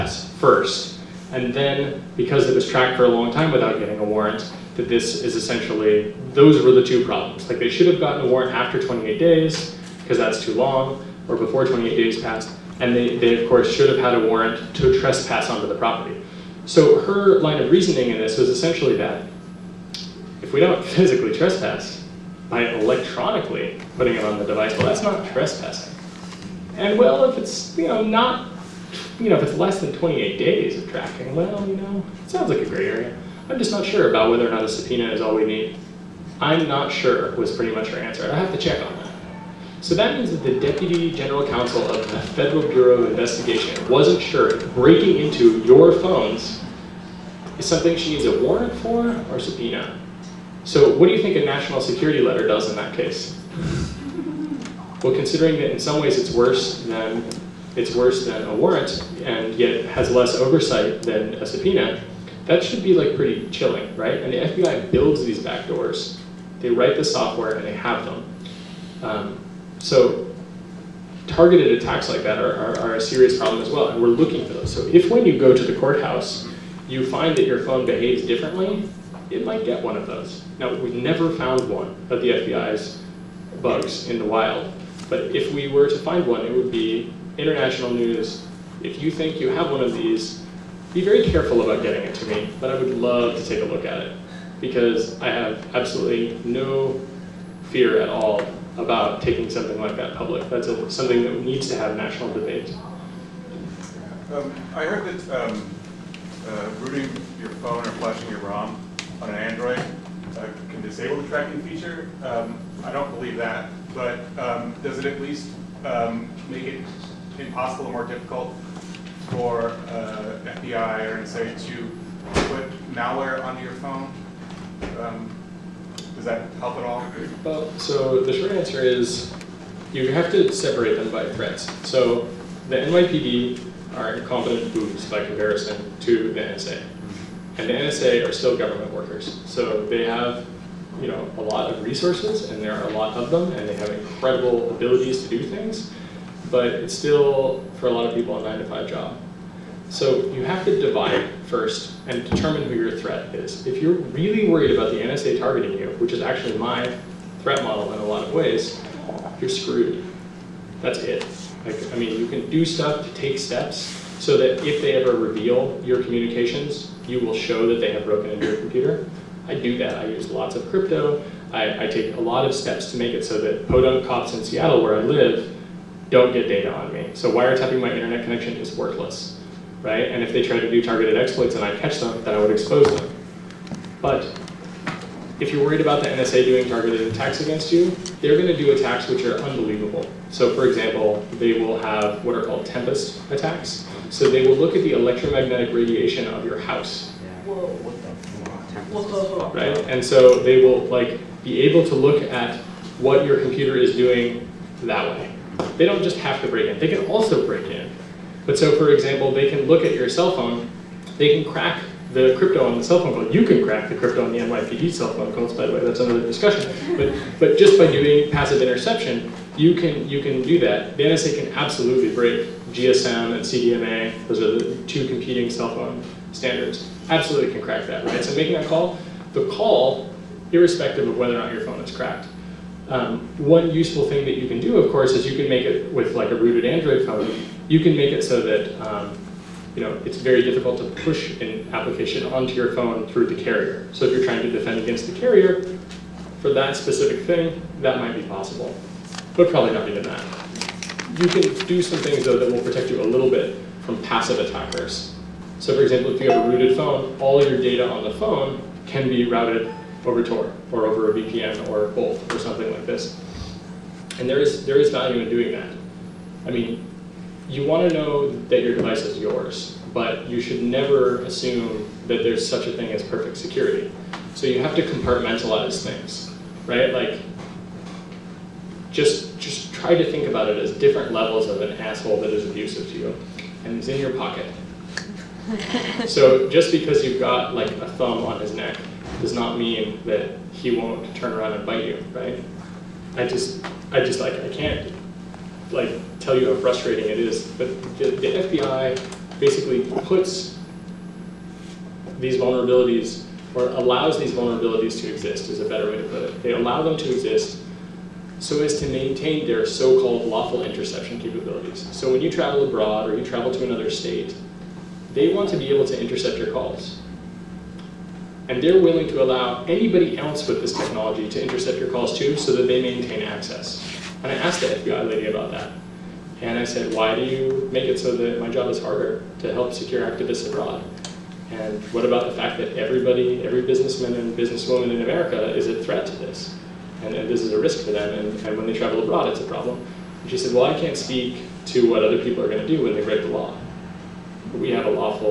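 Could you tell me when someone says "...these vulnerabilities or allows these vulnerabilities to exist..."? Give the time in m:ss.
5:02.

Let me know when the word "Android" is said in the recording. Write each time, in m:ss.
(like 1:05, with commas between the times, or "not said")
1:49, 3:56.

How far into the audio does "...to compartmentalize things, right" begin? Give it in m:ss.
4:34.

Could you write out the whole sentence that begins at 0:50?
So what do you think a national security letter does in that case?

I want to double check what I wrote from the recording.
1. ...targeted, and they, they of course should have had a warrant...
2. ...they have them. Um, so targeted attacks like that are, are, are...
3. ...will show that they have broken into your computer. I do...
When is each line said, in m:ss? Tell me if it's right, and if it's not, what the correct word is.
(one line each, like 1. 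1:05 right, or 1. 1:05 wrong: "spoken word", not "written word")
1. 0:12 wrong: "passed", not "targeted"
2. 1:07 right
3. 2:47 right.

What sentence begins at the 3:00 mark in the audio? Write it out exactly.
And if they try to do targeted exploits and I catch them, then I would expose them.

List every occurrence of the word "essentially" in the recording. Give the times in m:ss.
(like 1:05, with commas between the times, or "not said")
0:05, 0:18.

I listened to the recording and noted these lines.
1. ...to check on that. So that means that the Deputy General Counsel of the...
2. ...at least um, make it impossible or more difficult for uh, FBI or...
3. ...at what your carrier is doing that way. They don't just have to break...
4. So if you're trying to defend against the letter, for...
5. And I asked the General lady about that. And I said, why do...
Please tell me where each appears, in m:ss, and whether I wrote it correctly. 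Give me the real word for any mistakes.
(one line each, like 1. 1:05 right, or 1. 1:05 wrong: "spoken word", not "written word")
1. 0:38 right
2. 1:55 right
3. 3:22 wrong: "computer", not "carrier"
4. 4:03 wrong: "carrier", not "letter"
5. 5:24 wrong: "FBI", not "General".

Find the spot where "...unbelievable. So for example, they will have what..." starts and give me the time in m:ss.
3:09.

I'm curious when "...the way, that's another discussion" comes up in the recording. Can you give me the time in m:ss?
3:35.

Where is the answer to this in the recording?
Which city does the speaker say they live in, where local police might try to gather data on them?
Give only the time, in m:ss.
2:54.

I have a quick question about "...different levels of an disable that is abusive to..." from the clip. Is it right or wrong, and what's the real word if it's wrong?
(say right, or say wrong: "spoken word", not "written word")
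wrong: "asshole", not "disable".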